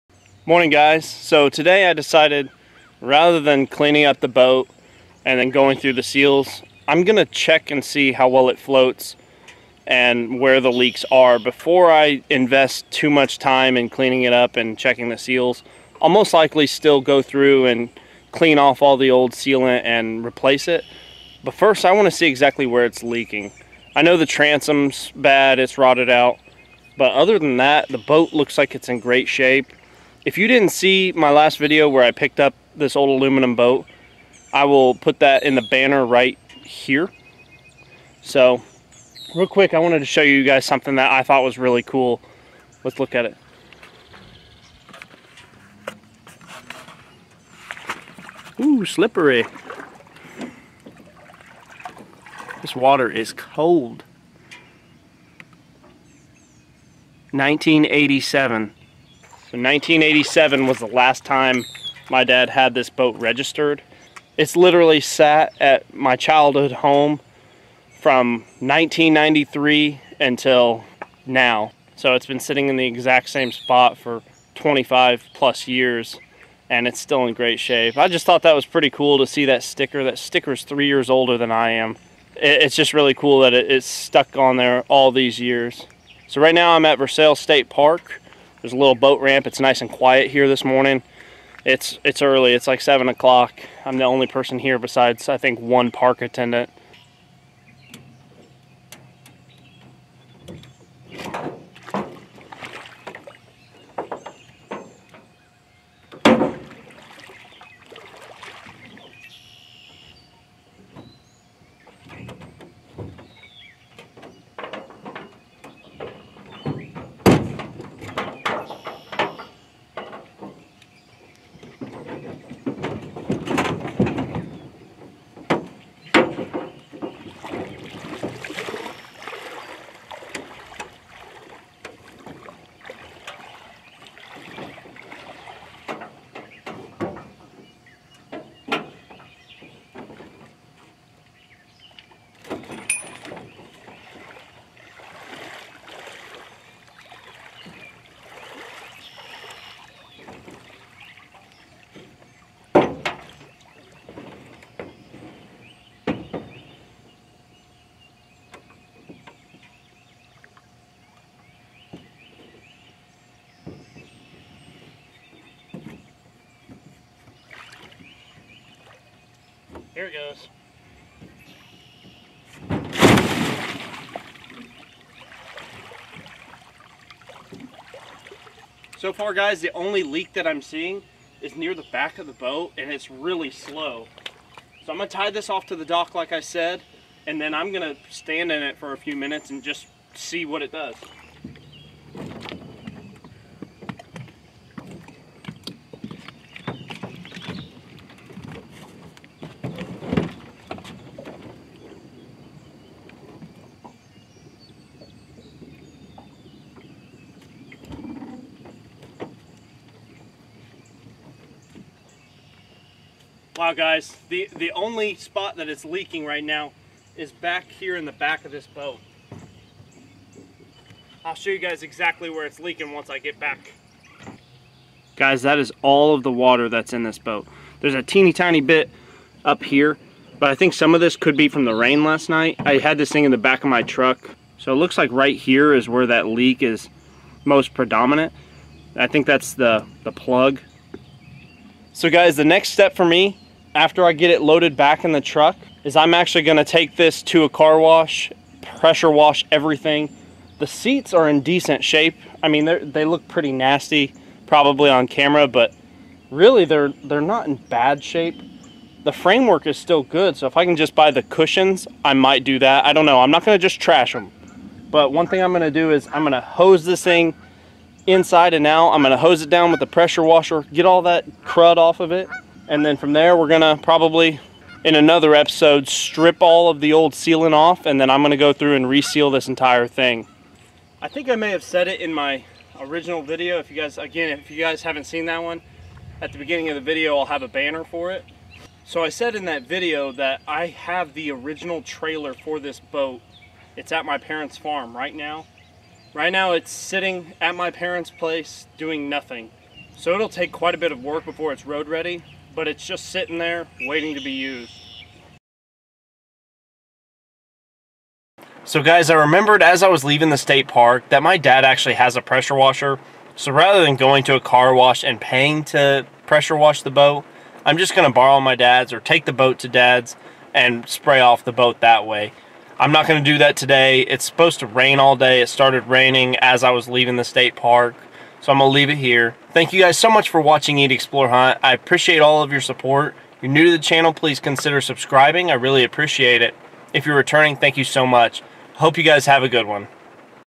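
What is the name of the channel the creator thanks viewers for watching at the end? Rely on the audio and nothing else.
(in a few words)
Eat Explore Hunt.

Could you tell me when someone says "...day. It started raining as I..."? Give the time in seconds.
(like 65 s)
325 s.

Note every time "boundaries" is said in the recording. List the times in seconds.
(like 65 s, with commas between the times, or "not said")
not said.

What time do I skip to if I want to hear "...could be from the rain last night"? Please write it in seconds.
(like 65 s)
231 s.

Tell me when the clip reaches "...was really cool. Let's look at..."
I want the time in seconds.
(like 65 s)
41 s.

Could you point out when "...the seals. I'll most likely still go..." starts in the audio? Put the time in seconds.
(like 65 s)
15 s.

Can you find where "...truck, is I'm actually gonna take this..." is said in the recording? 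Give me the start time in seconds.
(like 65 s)
245 s.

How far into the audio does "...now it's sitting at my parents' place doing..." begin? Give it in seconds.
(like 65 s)
296 s.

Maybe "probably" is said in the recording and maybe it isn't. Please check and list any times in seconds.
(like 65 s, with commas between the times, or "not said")
254 s, 273 s.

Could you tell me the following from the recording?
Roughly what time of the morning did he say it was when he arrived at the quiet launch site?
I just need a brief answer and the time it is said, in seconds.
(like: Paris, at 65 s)
7 o'clock, at 92 s.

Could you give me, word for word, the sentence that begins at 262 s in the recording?
I don't know, I'm not gonna just trash them.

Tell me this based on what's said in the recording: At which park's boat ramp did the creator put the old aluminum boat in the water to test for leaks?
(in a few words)
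Versailles State Park.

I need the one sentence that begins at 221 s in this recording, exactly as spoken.
I'll show you guys exactly where it's leaking once I get back.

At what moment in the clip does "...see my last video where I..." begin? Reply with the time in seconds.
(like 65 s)
30 s.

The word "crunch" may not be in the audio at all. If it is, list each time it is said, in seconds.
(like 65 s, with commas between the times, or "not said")
not said.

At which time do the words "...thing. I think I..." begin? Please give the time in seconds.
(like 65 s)
279 s.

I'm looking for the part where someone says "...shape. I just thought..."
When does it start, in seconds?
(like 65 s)
77 s.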